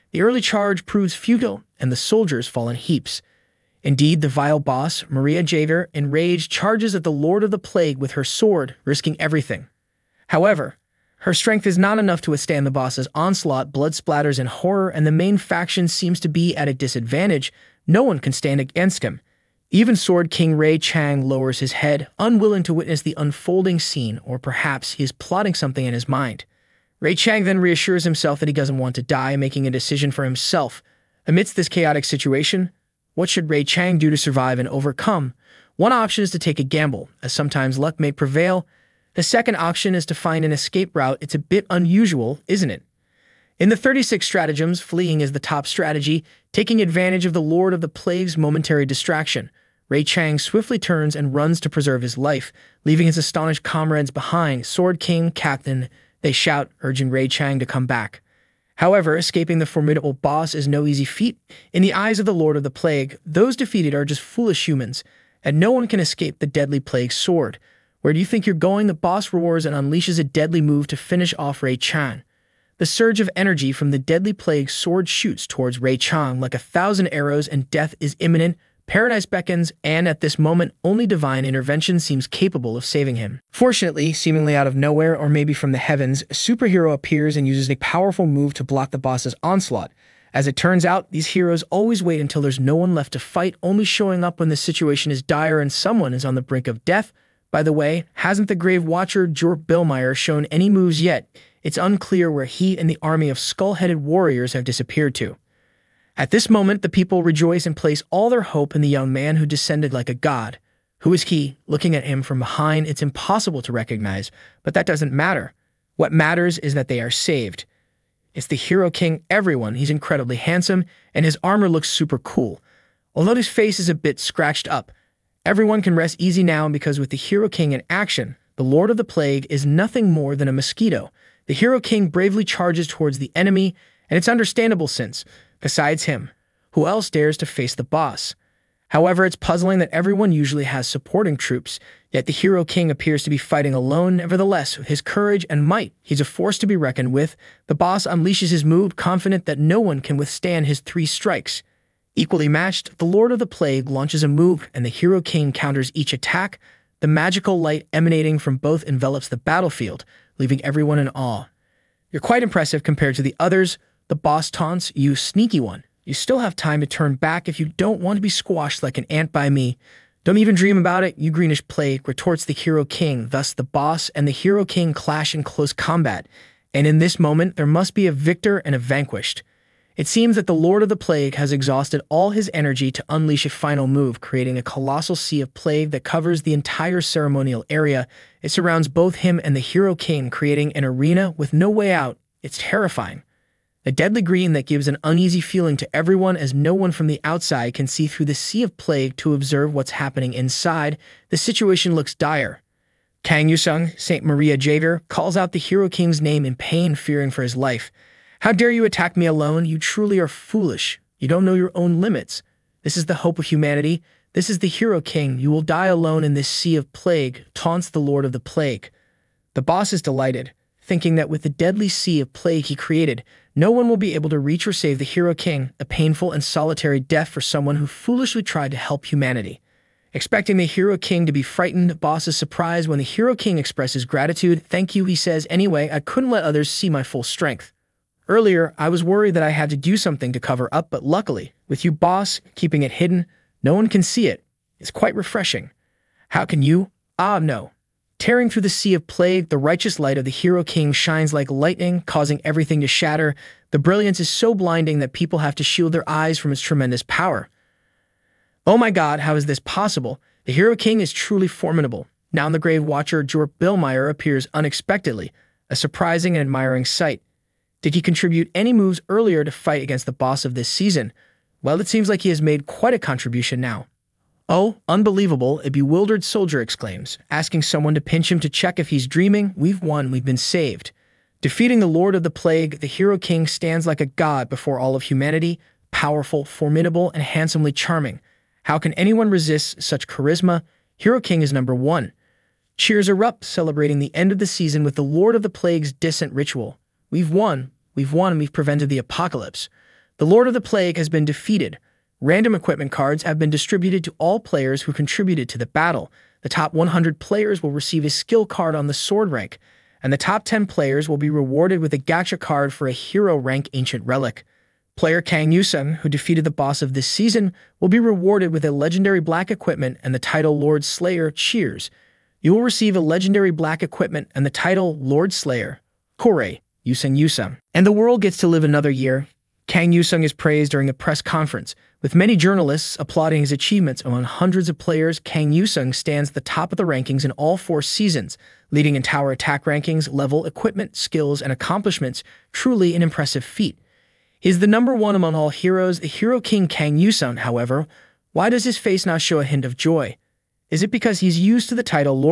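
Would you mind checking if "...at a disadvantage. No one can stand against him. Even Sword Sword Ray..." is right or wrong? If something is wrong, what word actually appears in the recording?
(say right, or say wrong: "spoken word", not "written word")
wrong: "King", not "Sword".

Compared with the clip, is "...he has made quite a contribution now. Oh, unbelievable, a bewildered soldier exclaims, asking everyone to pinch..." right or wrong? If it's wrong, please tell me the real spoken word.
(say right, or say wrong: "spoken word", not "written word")
wrong: "someone", not "everyone".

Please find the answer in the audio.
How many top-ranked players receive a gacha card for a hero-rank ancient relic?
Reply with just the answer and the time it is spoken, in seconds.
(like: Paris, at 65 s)
10, at 310 s.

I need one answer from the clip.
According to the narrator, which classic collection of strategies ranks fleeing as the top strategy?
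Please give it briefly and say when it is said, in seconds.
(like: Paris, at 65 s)
The 36 stratagems, at 43 s.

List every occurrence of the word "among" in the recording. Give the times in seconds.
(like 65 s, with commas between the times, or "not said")
334 s, 345 s.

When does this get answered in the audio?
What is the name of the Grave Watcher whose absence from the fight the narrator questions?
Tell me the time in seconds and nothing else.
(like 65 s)
99 s.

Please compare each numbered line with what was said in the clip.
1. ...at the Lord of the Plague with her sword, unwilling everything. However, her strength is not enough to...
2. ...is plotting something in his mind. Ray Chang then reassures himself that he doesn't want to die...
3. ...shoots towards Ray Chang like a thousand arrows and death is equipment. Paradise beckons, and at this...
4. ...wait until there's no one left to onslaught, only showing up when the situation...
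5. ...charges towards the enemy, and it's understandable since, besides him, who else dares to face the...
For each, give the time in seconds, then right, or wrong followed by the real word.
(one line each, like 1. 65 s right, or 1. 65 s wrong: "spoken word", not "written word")
1. 6 s wrong: "risking", not "unwilling"
2. 25 s right
3. 75 s wrong: "imminent", not "equipment"
4. 92 s wrong: "fight", not "onslaught"
5. 132 s right.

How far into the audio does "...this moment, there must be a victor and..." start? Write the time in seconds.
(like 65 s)
176 s.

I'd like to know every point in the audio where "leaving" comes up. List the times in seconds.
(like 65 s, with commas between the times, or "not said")
52 s, 160 s.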